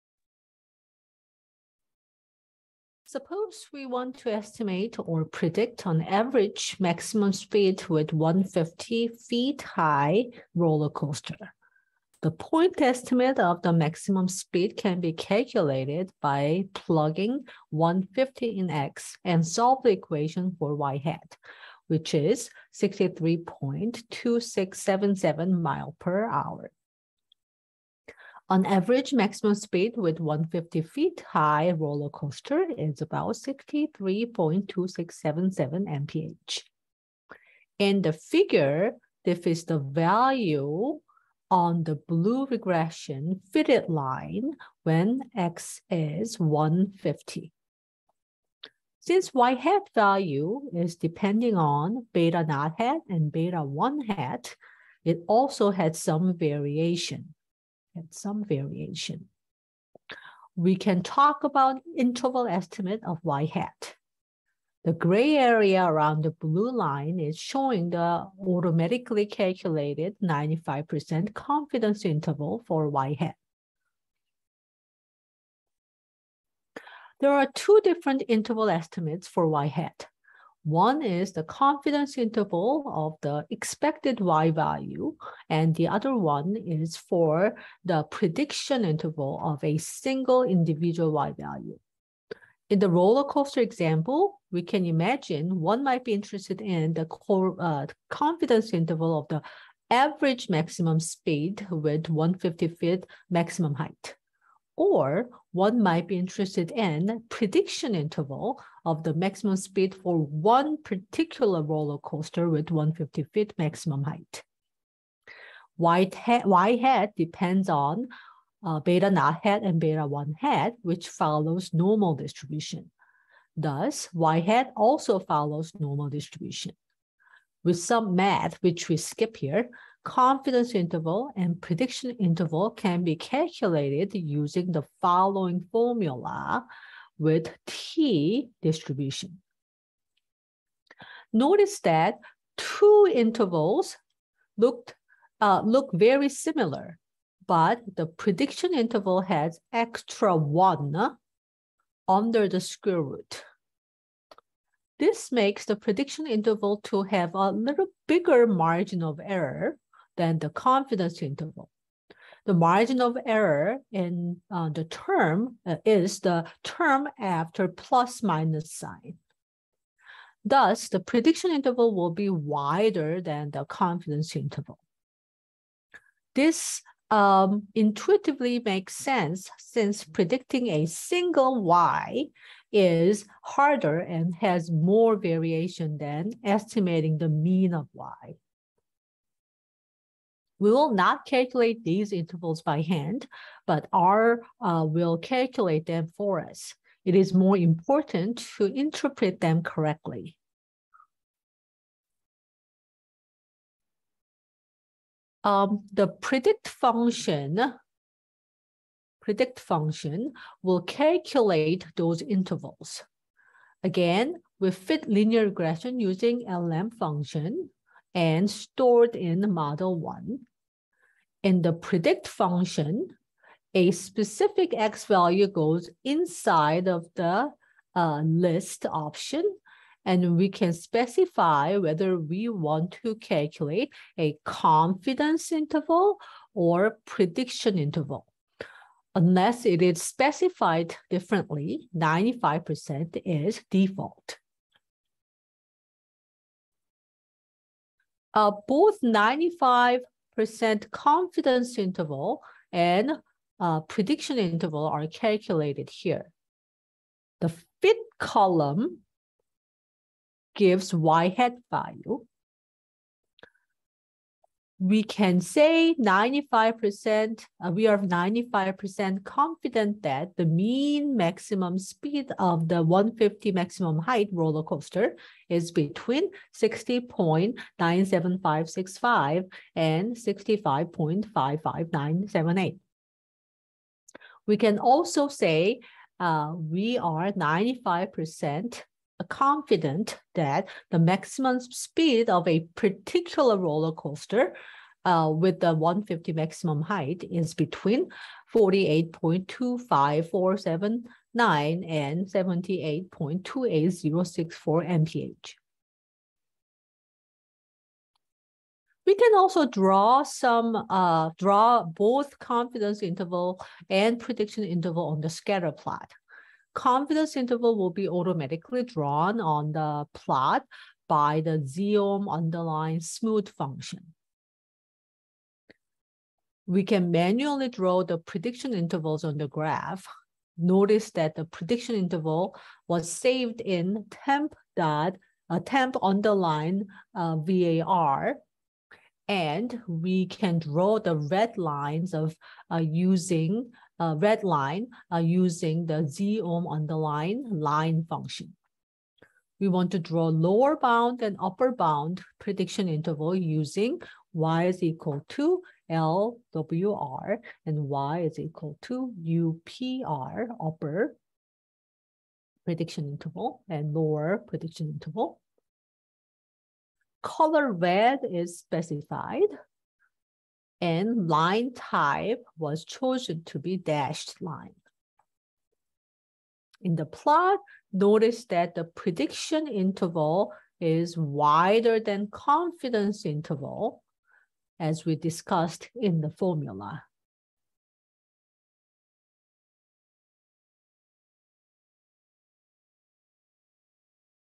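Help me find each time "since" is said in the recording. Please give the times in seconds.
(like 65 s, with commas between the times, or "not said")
48 s, 179 s.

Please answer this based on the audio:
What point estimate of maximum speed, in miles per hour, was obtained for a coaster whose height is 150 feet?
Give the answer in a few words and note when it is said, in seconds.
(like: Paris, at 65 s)
63.2677, at 22 s.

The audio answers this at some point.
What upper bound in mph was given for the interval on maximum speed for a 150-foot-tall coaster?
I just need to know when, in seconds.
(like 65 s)
302 s.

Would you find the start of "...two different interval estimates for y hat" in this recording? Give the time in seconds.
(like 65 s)
77 s.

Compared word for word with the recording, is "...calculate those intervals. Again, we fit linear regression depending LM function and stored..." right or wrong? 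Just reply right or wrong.
wrong.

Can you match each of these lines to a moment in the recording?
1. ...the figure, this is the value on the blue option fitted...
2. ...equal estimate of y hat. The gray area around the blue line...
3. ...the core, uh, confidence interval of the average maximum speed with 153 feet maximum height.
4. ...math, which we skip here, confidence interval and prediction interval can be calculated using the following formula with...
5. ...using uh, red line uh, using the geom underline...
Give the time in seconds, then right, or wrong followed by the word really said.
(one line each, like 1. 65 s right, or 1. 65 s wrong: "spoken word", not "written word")
1. 38 s wrong: "regression", not "option"
2. 61 s wrong: "interval", not "equal"
3. 96 s wrong: "150", not "153"
4. 128 s right
5. 342 s right.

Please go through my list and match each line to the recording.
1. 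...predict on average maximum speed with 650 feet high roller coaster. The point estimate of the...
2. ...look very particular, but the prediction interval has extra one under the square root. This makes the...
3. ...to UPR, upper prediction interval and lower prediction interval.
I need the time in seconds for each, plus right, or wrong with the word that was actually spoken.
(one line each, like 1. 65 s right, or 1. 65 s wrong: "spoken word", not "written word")
1. 5 s wrong: "150", not "650"
2. 145 s wrong: "similar", not "particular"
3. 358 s right.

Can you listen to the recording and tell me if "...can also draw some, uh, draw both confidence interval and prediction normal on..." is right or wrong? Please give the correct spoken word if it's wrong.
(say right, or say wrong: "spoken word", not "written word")
wrong: "interval", not "normal".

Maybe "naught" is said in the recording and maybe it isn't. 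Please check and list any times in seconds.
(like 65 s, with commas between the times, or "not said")
52 s, 119 s.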